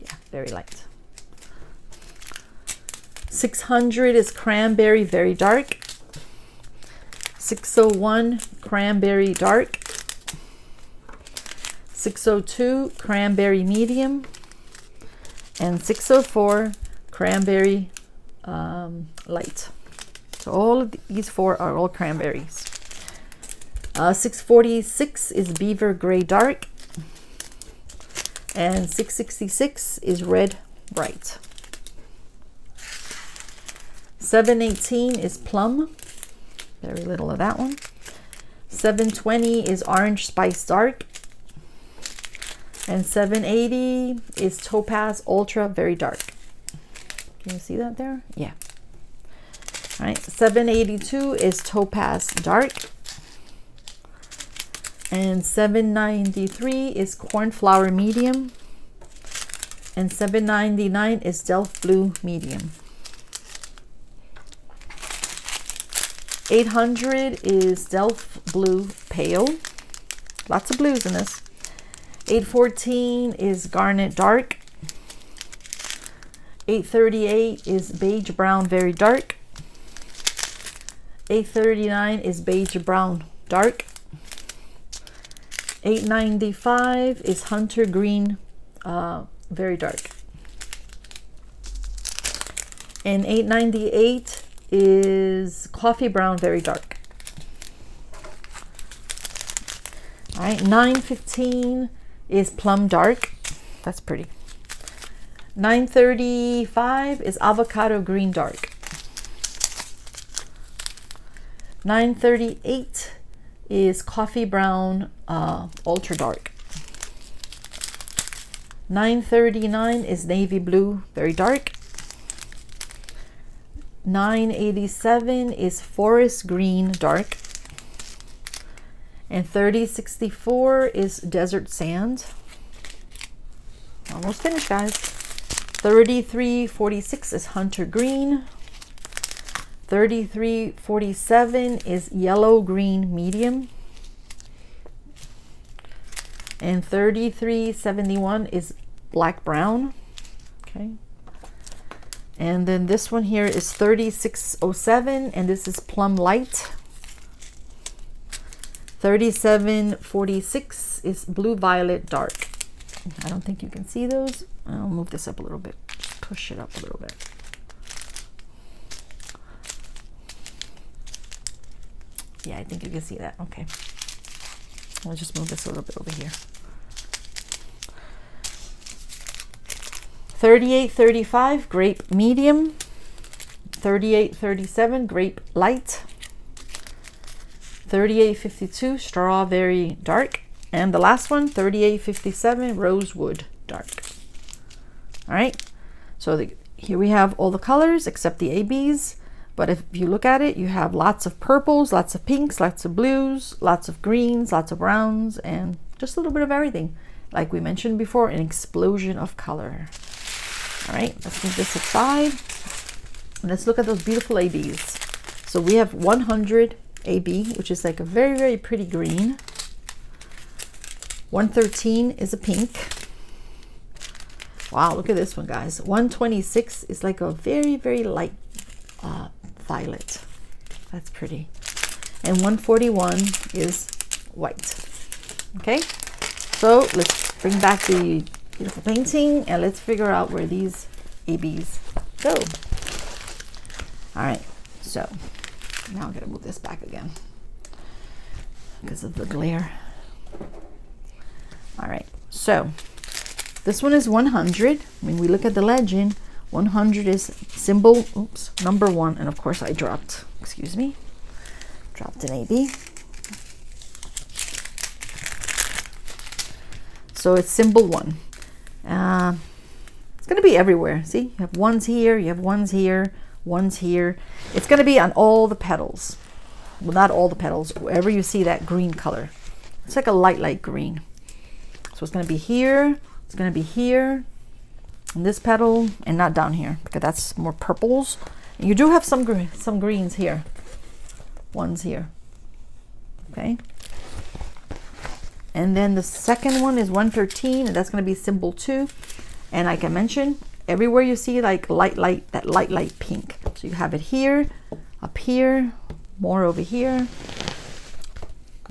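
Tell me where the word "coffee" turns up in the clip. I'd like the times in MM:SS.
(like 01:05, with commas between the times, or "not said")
01:35, 01:54.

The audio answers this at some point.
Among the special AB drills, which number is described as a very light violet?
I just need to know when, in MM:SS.
03:45.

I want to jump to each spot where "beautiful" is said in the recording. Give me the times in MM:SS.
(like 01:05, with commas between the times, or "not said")
03:34, 03:58.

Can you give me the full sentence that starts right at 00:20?
So all of these four are all cranberries.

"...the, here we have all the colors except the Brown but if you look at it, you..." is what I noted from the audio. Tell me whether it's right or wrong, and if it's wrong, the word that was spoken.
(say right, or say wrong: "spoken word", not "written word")
wrong: "ABs", not "Brown".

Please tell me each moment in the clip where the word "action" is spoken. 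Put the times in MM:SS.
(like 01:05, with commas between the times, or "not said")
not said.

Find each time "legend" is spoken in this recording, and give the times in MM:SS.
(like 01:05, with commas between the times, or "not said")
04:15.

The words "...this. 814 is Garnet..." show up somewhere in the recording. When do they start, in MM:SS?
01:11.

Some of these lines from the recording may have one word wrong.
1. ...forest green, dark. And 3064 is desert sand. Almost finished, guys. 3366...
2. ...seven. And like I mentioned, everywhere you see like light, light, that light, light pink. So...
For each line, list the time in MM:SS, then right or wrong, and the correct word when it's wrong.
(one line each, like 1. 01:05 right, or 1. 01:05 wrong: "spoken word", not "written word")
1. 02:05 wrong: "3346", not "3366"
2. 04:58 wrong: "two", not "seven".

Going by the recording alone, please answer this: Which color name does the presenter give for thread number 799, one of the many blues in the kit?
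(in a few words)
Delft Blue medium.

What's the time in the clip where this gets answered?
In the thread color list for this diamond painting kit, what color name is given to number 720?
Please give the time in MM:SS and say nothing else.
00:39.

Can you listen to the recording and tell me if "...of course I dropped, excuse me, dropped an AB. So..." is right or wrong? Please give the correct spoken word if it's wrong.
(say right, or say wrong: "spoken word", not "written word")
right.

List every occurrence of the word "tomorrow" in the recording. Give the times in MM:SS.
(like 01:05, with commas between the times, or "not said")
not said.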